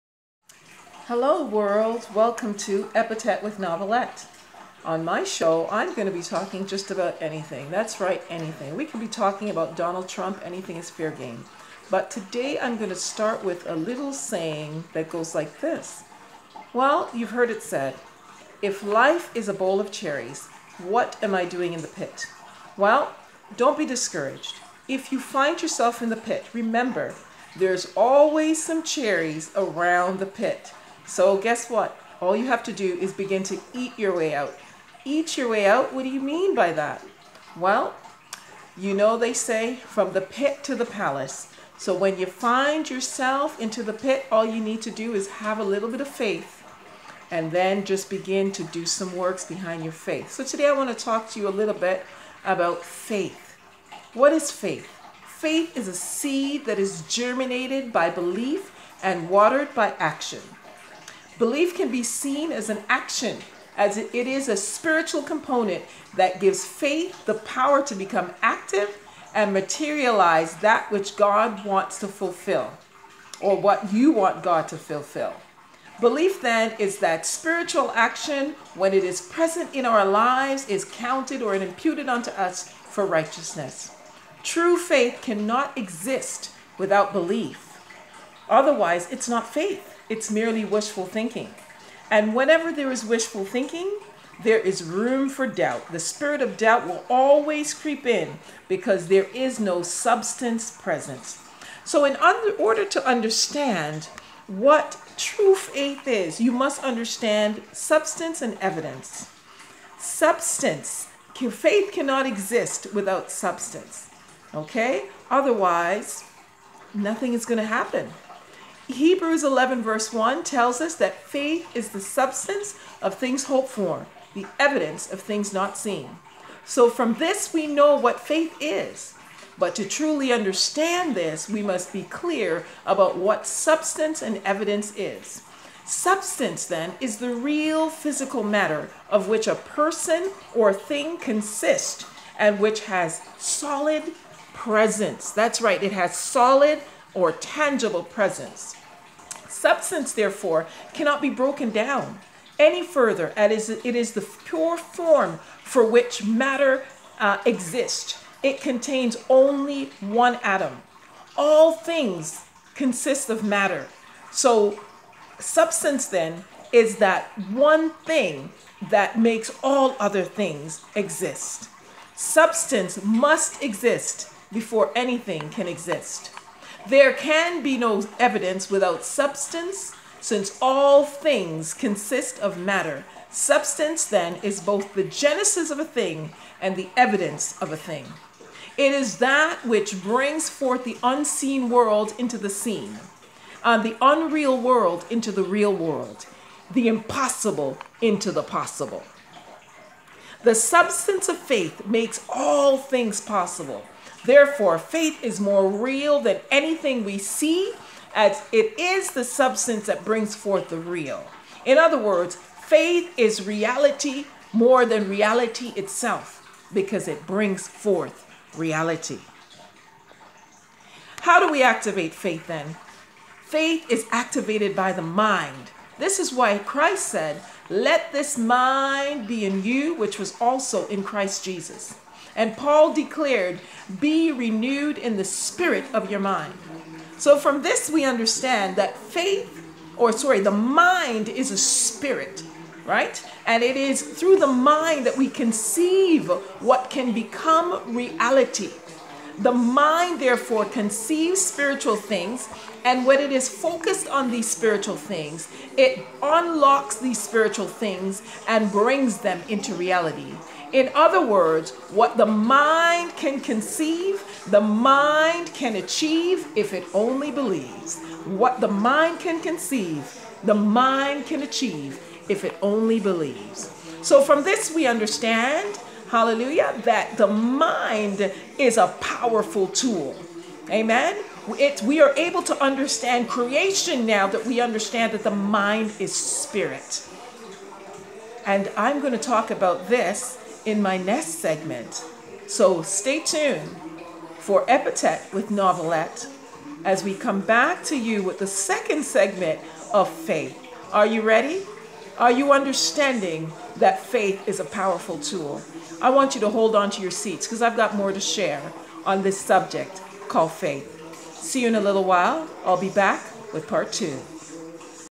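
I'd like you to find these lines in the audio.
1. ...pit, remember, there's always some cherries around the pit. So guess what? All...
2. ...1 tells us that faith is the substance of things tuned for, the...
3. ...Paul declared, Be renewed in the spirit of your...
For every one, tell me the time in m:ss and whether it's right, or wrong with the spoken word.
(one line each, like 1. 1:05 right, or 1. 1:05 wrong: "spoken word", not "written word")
1. 0:26 right
2. 2:00 wrong: "hoped", not "tuned"
3. 3:52 right.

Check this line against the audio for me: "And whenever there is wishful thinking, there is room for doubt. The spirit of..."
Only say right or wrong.
right.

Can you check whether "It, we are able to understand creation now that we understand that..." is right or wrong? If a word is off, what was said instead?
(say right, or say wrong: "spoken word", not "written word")
right.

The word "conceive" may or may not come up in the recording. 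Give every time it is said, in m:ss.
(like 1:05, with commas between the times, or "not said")
4:05, 4:10, 4:23, 4:29.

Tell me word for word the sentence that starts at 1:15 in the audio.
Belief then is that spiritual action, when it is present in our lives, is counted or imputed unto us for righteousness.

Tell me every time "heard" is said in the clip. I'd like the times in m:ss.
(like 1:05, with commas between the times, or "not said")
0:17.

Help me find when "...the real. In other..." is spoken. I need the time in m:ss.
3:30.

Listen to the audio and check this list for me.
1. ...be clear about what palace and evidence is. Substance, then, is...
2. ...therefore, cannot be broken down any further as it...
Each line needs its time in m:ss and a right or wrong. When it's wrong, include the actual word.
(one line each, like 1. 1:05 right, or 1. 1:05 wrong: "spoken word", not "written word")
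1. 2:11 wrong: "substance", not "palace"
2. 2:30 right.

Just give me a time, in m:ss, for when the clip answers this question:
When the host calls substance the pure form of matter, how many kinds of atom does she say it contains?
2:39.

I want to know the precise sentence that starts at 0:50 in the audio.
So today I want to talk to you a little bit about faith.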